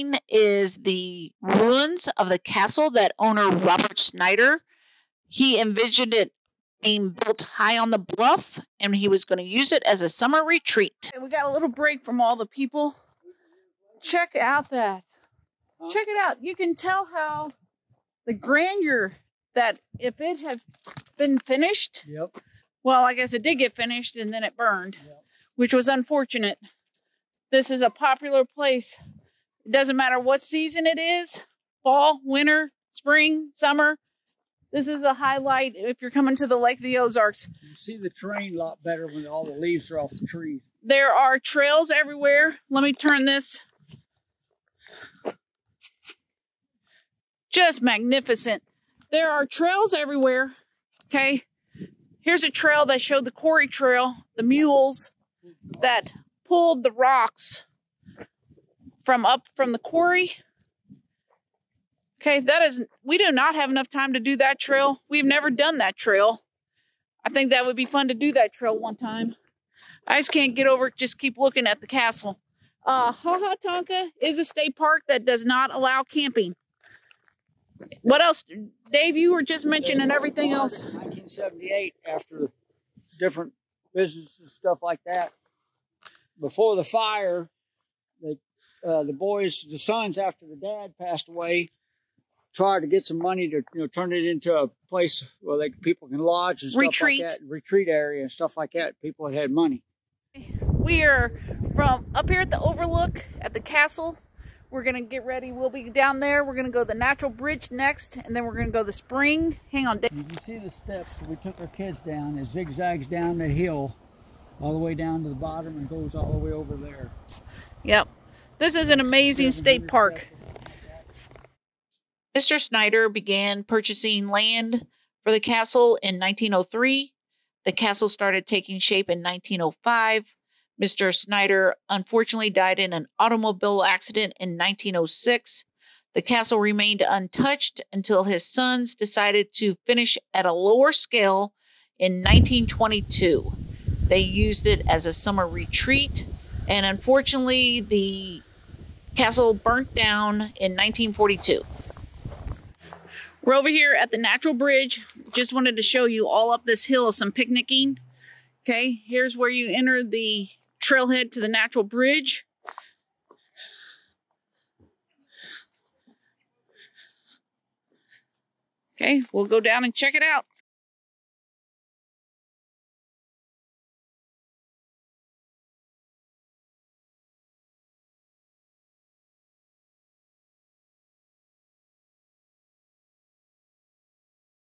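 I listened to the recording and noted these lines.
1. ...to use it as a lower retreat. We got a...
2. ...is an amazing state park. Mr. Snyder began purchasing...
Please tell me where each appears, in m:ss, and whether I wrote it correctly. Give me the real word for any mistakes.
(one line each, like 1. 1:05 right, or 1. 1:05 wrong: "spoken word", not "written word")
1. 0:09 wrong: "summer", not "lower"
2. 1:58 right.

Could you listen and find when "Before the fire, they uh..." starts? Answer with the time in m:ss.
1:26.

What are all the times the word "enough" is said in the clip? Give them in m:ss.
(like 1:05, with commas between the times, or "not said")
1:03.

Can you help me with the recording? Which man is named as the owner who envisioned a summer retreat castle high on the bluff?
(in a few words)
Robert Snyder.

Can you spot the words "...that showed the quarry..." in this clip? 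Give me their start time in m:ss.
0:52.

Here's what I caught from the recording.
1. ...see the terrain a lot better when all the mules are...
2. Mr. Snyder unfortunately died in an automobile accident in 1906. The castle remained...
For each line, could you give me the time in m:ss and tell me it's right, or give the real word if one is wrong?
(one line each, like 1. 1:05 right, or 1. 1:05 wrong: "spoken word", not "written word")
1. 0:37 wrong: "leaves", not "mules"
2. 2:10 right.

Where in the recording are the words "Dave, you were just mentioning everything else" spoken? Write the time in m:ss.
1:18.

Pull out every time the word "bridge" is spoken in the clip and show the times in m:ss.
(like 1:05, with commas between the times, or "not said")
1:47, 2:34, 2:41.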